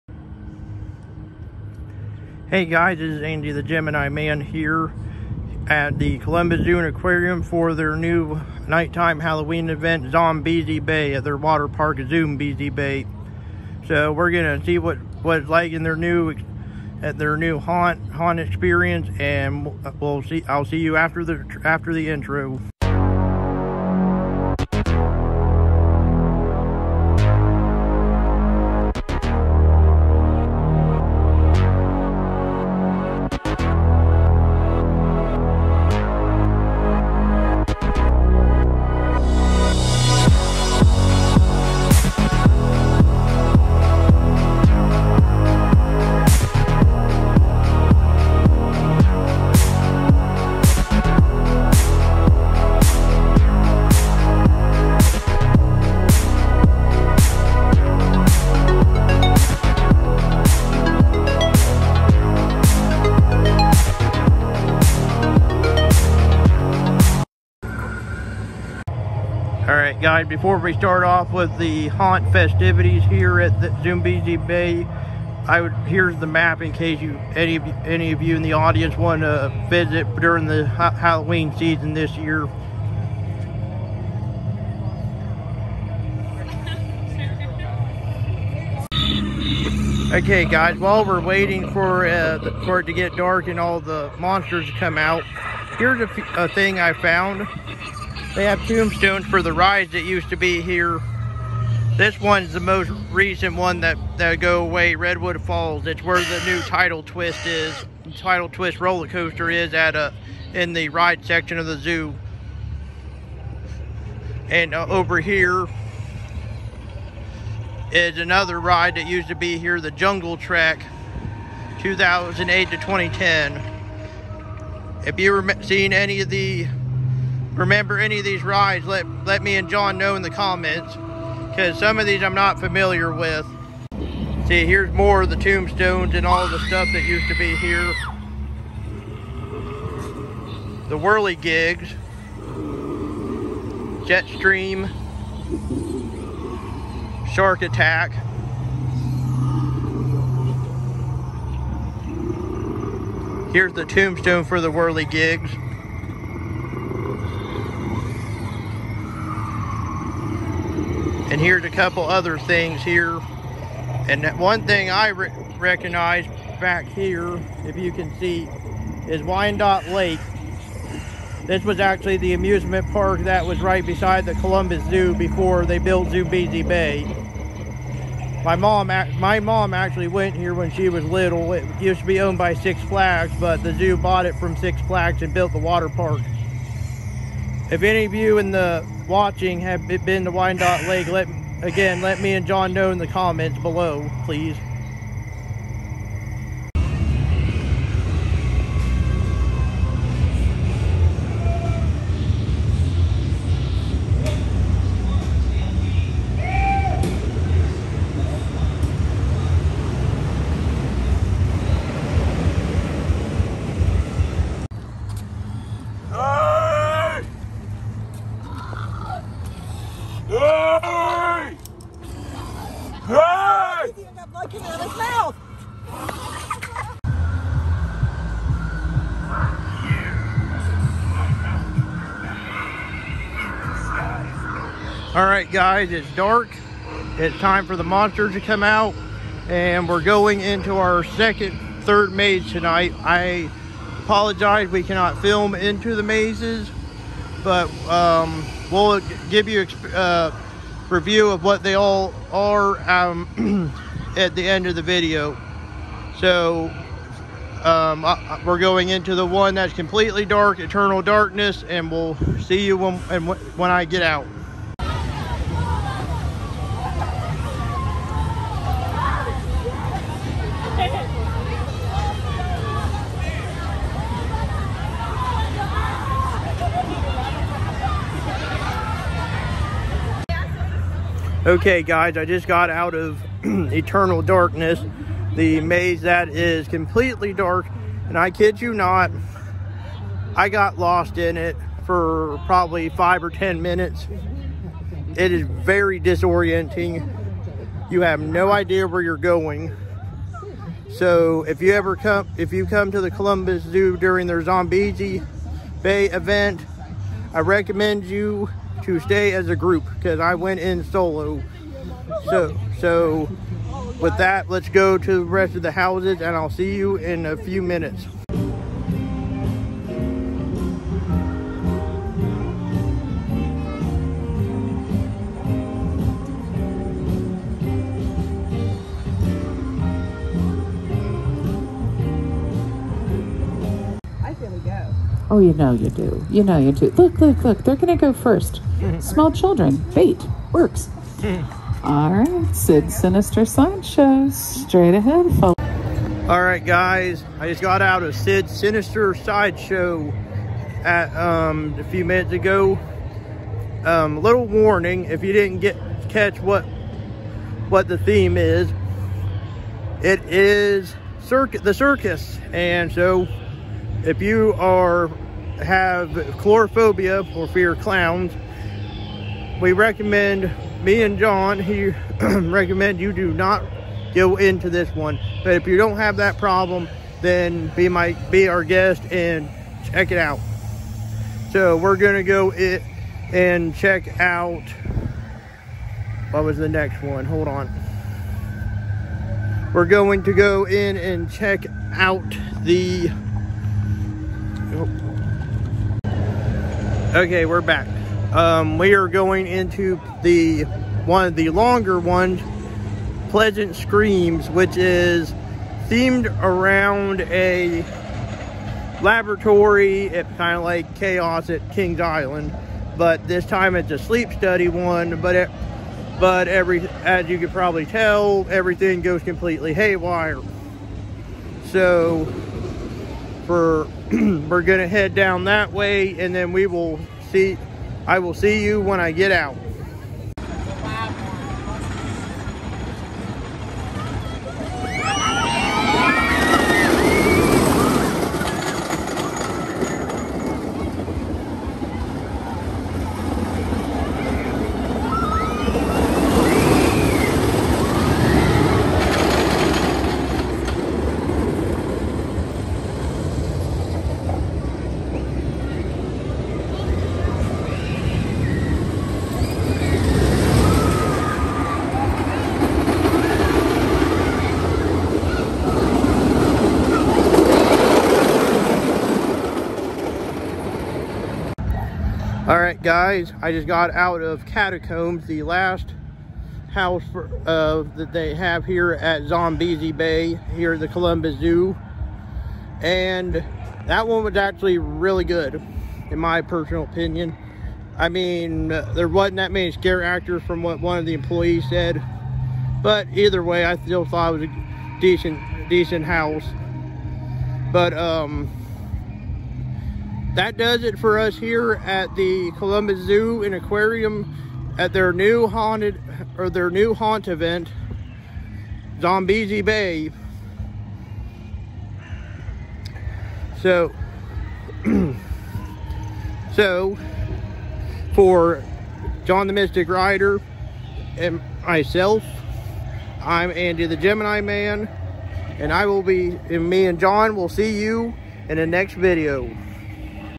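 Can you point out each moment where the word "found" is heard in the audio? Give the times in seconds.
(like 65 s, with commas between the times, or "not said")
96 s.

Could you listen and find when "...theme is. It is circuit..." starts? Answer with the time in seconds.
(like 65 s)
357 s.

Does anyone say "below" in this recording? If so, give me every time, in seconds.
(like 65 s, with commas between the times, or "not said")
193 s.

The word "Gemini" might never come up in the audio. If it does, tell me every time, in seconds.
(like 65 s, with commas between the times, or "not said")
3 s, 523 s.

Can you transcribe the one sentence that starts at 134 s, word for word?
See, here's more of the tombstones and all the stuff that used to be here.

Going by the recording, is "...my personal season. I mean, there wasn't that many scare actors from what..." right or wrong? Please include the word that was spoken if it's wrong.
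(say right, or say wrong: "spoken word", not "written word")
wrong: "opinion", not "season".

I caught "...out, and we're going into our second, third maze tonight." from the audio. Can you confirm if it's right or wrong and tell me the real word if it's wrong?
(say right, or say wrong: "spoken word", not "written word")
right.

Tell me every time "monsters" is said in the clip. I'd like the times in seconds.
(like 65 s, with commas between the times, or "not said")
94 s, 237 s.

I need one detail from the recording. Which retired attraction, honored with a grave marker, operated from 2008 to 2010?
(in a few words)
Jungle Track.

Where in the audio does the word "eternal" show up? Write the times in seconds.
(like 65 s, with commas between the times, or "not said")
260 s, 283 s.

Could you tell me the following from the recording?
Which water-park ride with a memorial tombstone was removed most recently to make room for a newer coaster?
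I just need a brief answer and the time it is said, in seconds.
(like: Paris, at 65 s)
Redwood Falls, at 104 s.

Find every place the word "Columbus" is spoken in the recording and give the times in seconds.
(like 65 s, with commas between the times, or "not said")
6 s, 174 s, 303 s, 480 s, 502 s.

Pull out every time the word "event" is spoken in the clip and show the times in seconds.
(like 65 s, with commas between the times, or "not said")
9 s, 306 s, 507 s.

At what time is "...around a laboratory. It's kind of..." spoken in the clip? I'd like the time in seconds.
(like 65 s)
406 s.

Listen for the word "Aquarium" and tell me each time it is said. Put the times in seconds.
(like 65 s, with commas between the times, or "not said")
6 s, 503 s.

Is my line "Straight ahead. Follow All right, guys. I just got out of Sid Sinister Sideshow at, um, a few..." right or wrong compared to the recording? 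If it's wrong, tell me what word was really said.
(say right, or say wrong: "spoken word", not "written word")
right.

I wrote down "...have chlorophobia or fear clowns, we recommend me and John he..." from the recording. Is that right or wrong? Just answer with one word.
right.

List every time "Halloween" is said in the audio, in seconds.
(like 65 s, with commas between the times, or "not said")
9 s, 80 s.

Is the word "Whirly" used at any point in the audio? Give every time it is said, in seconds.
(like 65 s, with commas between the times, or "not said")
140 s, 154 s.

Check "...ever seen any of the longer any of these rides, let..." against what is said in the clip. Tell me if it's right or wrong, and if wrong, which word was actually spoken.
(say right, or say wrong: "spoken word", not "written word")
wrong: "remember", not "longer".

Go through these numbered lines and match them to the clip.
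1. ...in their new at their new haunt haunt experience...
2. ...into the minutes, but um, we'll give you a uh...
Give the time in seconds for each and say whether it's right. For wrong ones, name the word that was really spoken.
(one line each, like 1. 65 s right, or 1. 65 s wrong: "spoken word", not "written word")
1. 15 s right
2. 245 s wrong: "mazes", not "minutes".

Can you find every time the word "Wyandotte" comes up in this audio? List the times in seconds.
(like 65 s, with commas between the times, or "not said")
169 s, 190 s.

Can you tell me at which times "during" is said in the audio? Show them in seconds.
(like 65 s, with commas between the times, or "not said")
80 s, 303 s.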